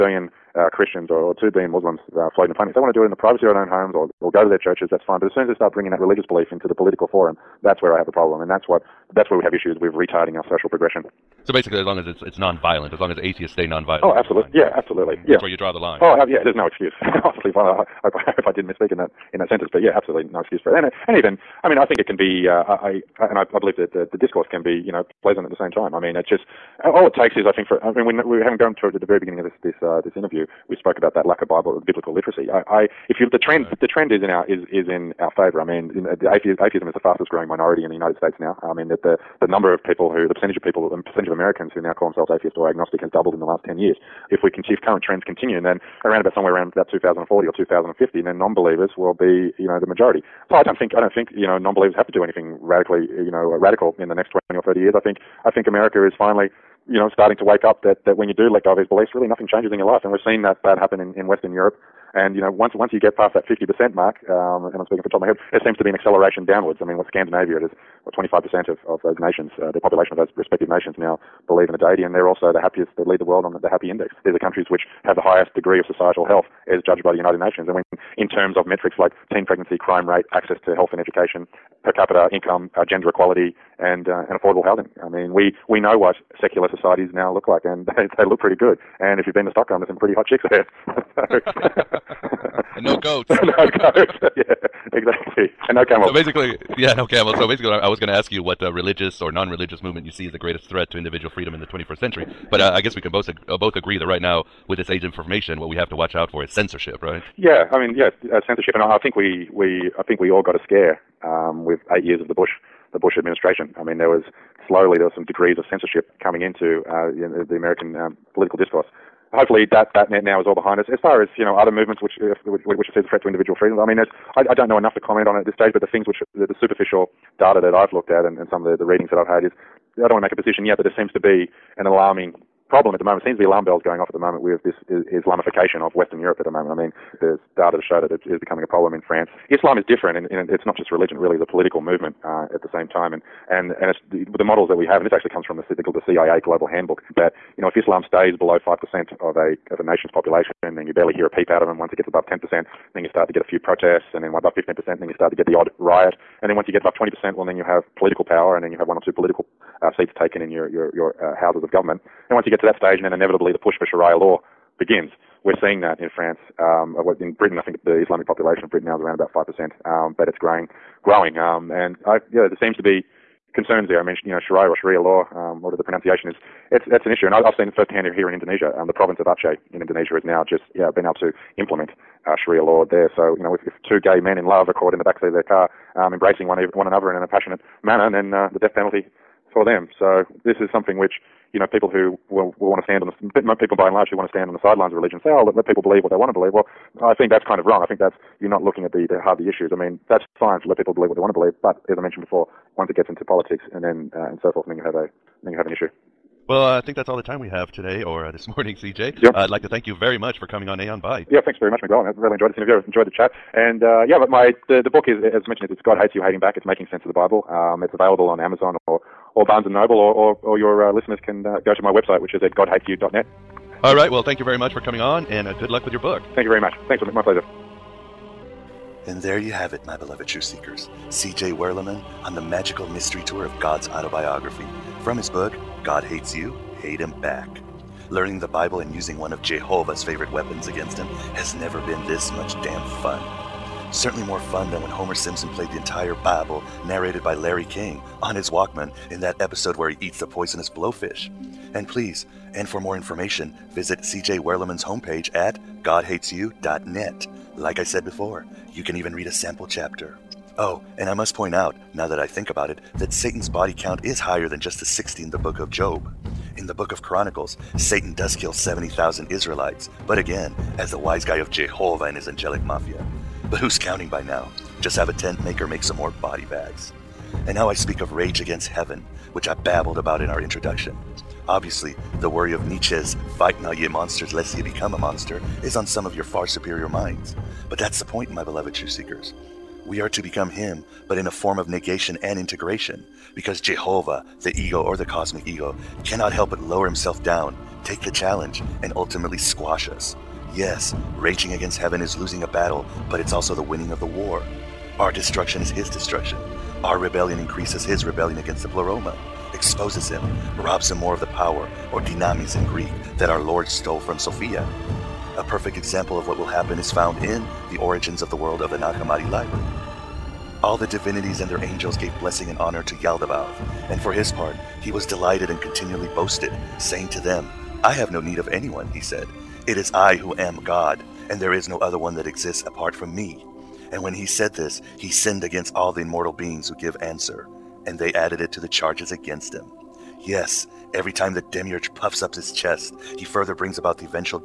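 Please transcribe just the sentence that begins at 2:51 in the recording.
Um, and I, yeah, there seems to be concerns there.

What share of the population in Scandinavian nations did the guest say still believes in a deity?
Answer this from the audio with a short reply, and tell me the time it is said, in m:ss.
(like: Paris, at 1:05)
25%, at 1:08.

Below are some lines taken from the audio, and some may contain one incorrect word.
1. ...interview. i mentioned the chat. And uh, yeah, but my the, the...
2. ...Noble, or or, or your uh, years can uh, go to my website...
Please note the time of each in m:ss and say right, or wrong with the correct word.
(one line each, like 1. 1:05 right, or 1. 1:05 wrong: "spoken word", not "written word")
1. 3:32 wrong: "enjoyed", not "mentioned"
2. 3:39 wrong: "listeners", not "years".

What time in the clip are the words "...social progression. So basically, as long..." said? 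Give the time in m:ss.
0:10.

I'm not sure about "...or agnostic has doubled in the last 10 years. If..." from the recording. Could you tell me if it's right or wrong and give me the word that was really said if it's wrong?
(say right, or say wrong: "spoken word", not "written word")
right.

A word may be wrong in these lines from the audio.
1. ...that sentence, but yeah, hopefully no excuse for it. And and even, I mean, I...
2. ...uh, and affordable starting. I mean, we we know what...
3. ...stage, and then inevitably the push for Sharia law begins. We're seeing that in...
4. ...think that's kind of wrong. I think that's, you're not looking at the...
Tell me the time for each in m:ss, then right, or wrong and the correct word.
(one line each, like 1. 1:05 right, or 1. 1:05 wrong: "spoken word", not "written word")
1. 0:19 wrong: "absolutely", not "hopefully"
2. 1:24 wrong: "housing", not "starting"
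3. 2:42 right
4. 3:17 right.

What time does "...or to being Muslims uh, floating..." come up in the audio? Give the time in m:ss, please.
0:01.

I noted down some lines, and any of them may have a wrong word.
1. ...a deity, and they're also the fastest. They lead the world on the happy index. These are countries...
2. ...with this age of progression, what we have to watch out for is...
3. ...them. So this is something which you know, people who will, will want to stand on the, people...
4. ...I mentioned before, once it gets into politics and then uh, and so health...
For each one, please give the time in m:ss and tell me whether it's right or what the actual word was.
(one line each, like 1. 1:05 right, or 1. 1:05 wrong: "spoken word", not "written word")
1. 1:11 wrong: "happiest", not "fastest"
2. 1:44 wrong: "information", not "progression"
3. 3:09 right
4. 3:21 wrong: "forth", not "health".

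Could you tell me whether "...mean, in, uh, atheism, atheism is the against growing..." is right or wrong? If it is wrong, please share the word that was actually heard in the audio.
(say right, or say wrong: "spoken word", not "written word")
wrong: "fastest", not "against".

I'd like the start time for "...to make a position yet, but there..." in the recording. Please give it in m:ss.
2:10.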